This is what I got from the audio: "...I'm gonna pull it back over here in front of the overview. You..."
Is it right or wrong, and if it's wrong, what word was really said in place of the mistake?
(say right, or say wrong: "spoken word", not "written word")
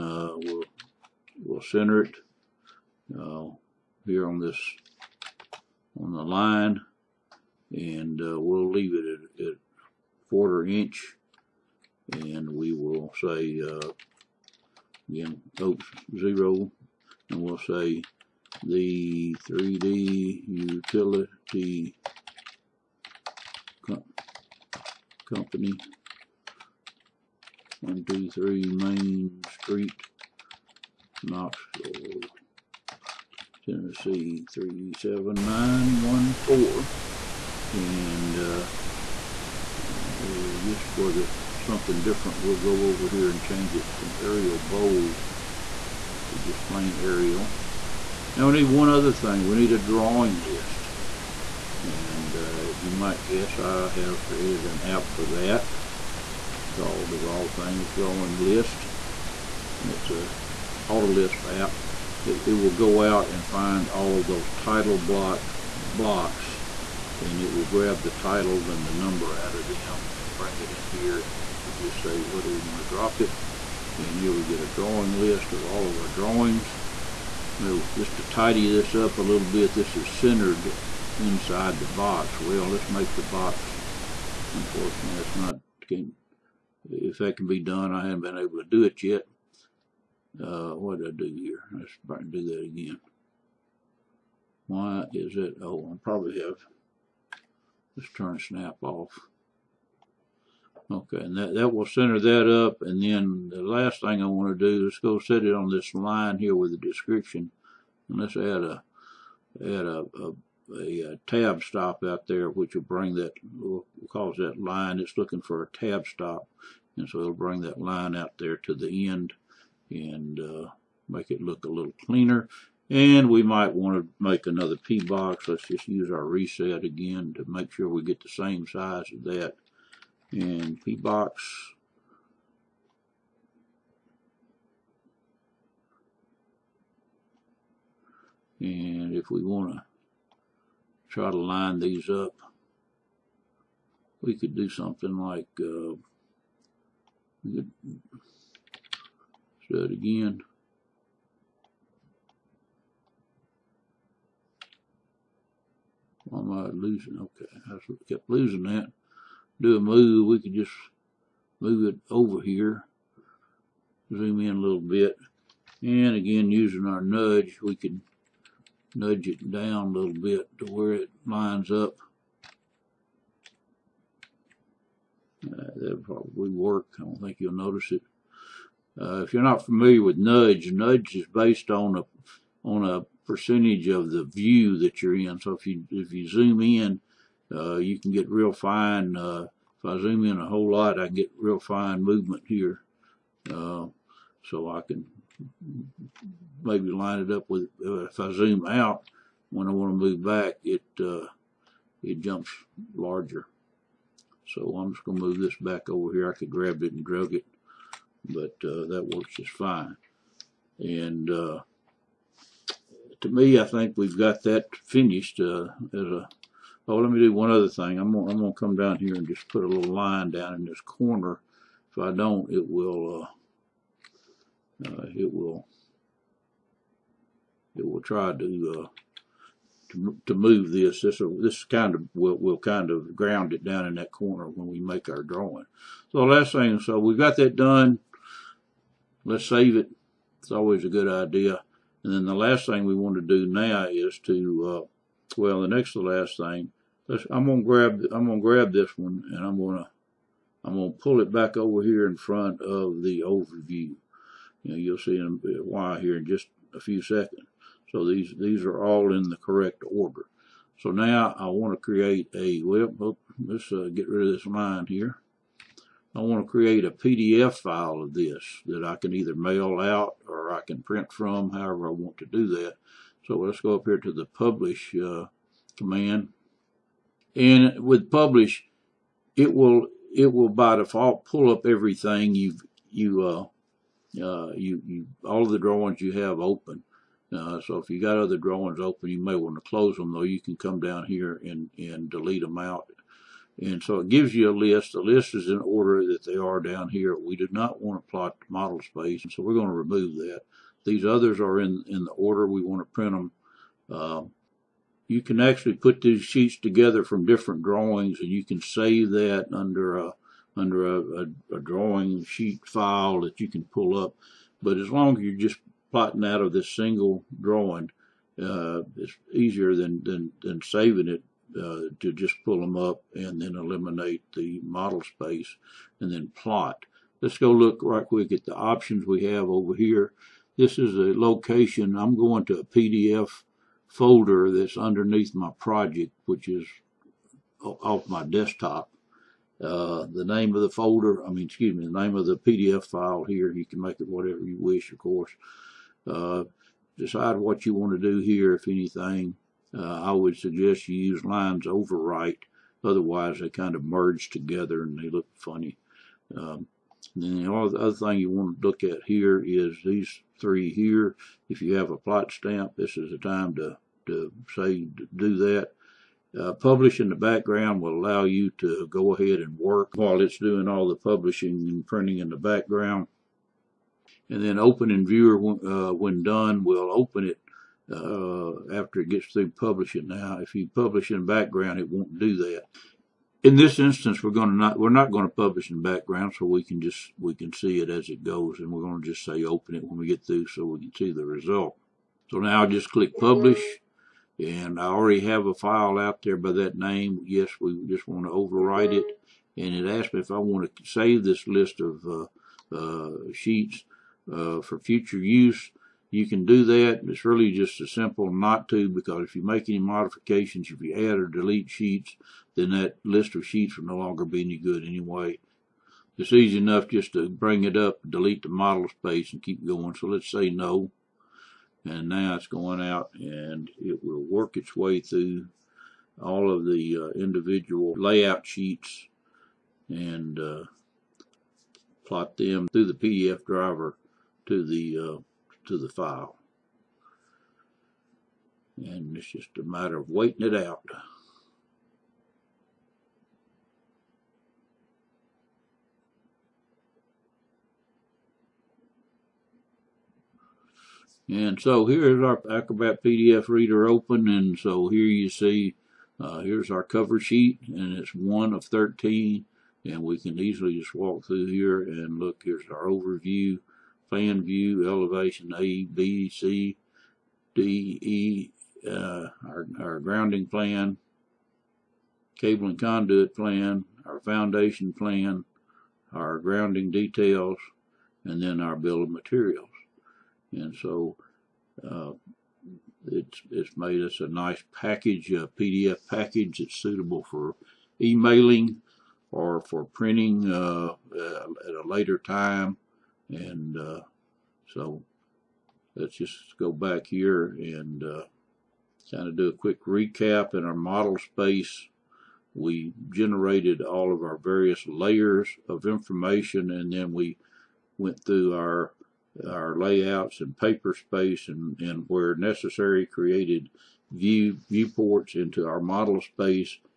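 right.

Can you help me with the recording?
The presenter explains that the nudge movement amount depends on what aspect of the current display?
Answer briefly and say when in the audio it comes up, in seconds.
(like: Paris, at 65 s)
percentage of the view, at 183 s.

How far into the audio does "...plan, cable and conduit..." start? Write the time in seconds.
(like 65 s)
470 s.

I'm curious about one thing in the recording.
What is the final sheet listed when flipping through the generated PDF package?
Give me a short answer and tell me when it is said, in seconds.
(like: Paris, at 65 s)
bill of materials, at 478 s.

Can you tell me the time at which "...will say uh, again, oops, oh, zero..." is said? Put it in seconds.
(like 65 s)
12 s.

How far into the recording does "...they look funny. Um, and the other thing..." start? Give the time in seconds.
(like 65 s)
354 s.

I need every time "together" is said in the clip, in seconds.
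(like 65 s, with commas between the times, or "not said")
306 s, 354 s.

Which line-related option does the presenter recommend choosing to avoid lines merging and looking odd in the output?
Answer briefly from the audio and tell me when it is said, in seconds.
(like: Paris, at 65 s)
lines overwrite, at 351 s.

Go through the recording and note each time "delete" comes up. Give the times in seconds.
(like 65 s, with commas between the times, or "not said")
292 s, 411 s, 418 s.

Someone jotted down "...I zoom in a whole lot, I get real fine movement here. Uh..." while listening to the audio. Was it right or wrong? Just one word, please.
right.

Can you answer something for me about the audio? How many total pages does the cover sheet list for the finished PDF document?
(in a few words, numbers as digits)
13.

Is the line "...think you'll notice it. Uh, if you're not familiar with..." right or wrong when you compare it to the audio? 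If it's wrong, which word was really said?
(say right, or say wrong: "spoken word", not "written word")
right.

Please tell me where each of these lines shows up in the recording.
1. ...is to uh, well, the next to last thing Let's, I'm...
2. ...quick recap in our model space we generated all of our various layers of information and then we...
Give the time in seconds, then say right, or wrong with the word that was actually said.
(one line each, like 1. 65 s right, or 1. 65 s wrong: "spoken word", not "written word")
1. 243 s right
2. 499 s right.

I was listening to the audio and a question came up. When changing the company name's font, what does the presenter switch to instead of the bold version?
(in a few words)
plain Arial.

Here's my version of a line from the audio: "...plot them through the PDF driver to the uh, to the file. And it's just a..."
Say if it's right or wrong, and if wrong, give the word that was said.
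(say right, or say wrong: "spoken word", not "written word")
right.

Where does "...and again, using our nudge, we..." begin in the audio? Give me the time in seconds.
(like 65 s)
165 s.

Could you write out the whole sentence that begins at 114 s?
It's looking for a tab stop.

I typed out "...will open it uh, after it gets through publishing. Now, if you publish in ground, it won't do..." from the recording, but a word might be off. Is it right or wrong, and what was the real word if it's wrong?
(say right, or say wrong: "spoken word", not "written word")
wrong: "background", not "ground".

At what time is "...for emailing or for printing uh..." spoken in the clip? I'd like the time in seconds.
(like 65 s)
487 s.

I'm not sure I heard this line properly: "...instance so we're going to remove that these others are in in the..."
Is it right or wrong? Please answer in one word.
wrong.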